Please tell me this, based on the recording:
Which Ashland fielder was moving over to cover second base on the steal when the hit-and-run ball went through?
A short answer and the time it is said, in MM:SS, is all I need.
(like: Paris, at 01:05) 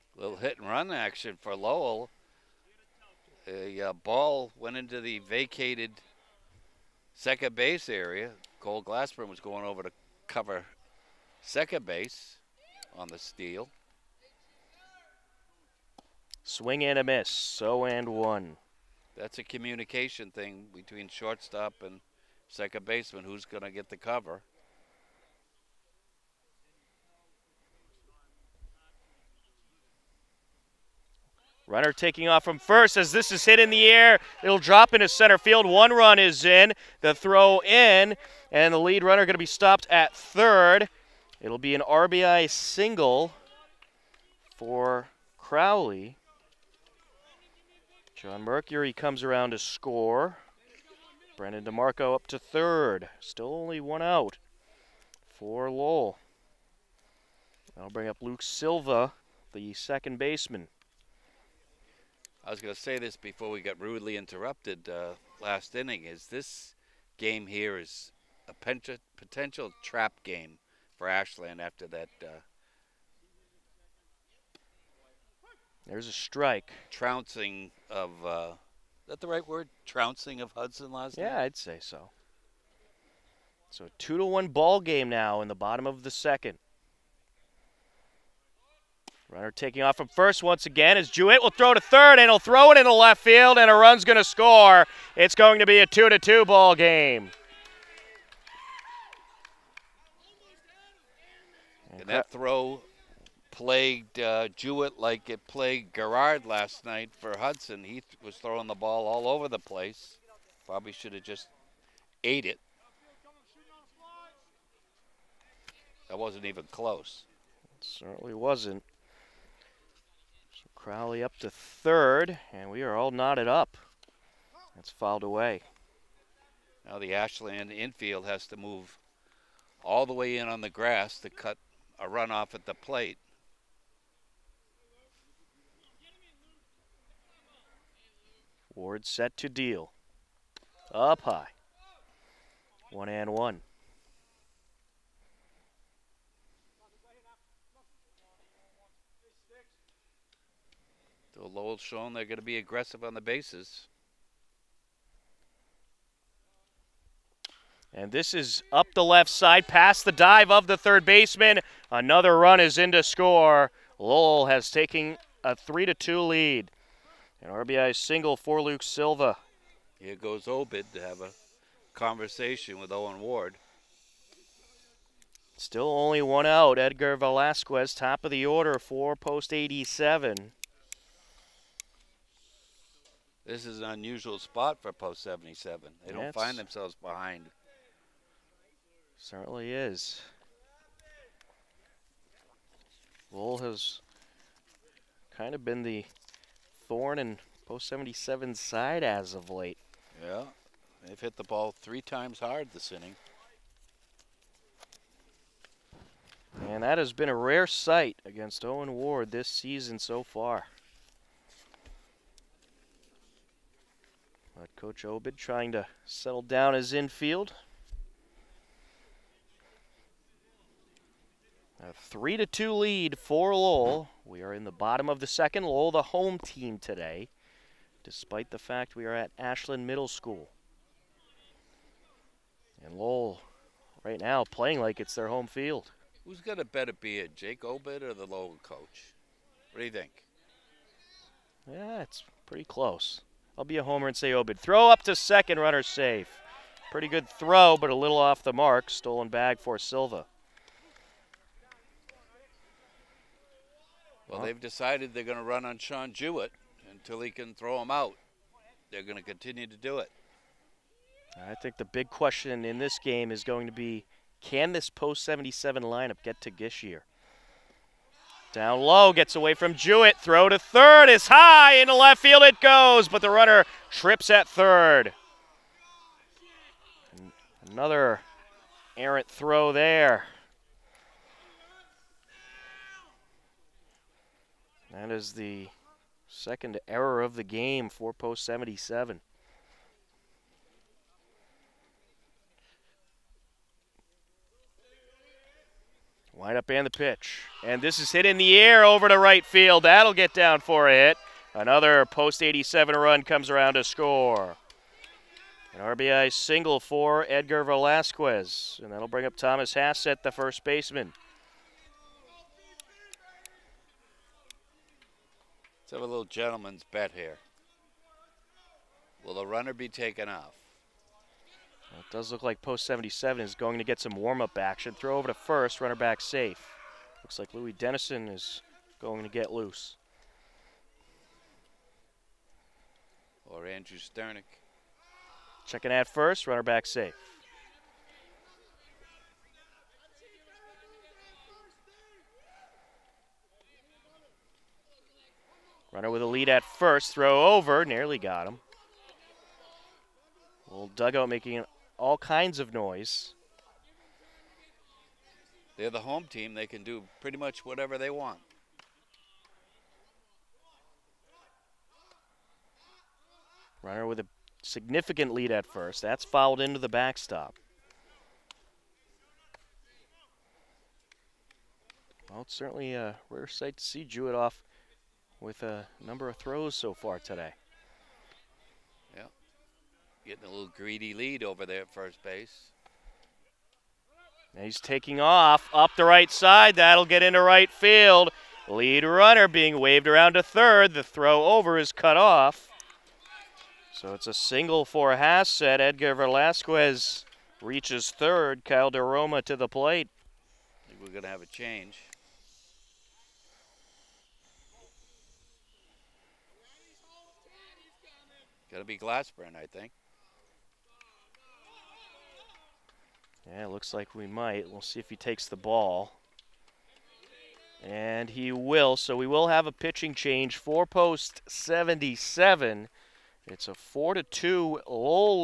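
Cole Glassburn, at 00:08.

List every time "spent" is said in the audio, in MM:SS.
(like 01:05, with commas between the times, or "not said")
not said.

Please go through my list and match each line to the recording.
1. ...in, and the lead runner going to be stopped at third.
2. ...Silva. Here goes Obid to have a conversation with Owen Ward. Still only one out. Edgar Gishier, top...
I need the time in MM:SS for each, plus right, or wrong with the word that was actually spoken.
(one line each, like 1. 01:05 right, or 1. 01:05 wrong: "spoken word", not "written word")
1. 00:37 right
2. 02:48 wrong: "Velasquez", not "Gishier".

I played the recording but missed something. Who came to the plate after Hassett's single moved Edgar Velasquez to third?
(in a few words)
Kyle DeRoma.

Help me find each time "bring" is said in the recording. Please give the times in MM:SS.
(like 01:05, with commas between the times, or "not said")
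00:57, 05:09.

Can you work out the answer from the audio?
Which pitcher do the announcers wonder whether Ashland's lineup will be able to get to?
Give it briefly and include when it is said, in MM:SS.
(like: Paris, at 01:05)
Gishier, at 04:26.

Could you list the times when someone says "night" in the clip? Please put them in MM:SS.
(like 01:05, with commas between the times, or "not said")
01:21, 01:46.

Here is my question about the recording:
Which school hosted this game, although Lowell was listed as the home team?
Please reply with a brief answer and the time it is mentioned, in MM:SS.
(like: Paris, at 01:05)
Ashland Middle School, at 03:49.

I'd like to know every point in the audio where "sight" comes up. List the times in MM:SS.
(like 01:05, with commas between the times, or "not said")
03:27, 06:13.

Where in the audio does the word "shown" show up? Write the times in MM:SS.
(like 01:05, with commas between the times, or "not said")
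02:31.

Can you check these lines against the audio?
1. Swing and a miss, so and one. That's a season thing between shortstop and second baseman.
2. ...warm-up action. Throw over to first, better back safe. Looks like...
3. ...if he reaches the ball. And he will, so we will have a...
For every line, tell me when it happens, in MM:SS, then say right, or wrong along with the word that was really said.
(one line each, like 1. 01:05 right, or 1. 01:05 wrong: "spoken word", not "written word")
1. 00:16 wrong: "communication", not "season"
2. 05:24 wrong: "runner", not "better"
3. 06:54 wrong: "takes", not "reaches".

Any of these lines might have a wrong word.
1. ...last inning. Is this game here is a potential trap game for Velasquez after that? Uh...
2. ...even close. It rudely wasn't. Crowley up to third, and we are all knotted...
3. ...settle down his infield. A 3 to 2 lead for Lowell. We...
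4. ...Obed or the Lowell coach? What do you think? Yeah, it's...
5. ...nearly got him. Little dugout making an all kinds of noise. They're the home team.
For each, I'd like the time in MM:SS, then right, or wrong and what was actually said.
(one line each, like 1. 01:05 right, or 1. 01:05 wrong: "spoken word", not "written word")
1. 01:05 wrong: "Ashland", not "Velasquez"
2. 01:56 wrong: "certainly", not "rudely"
3. 03:36 right
4. 03:57 right
5. 05:47 right.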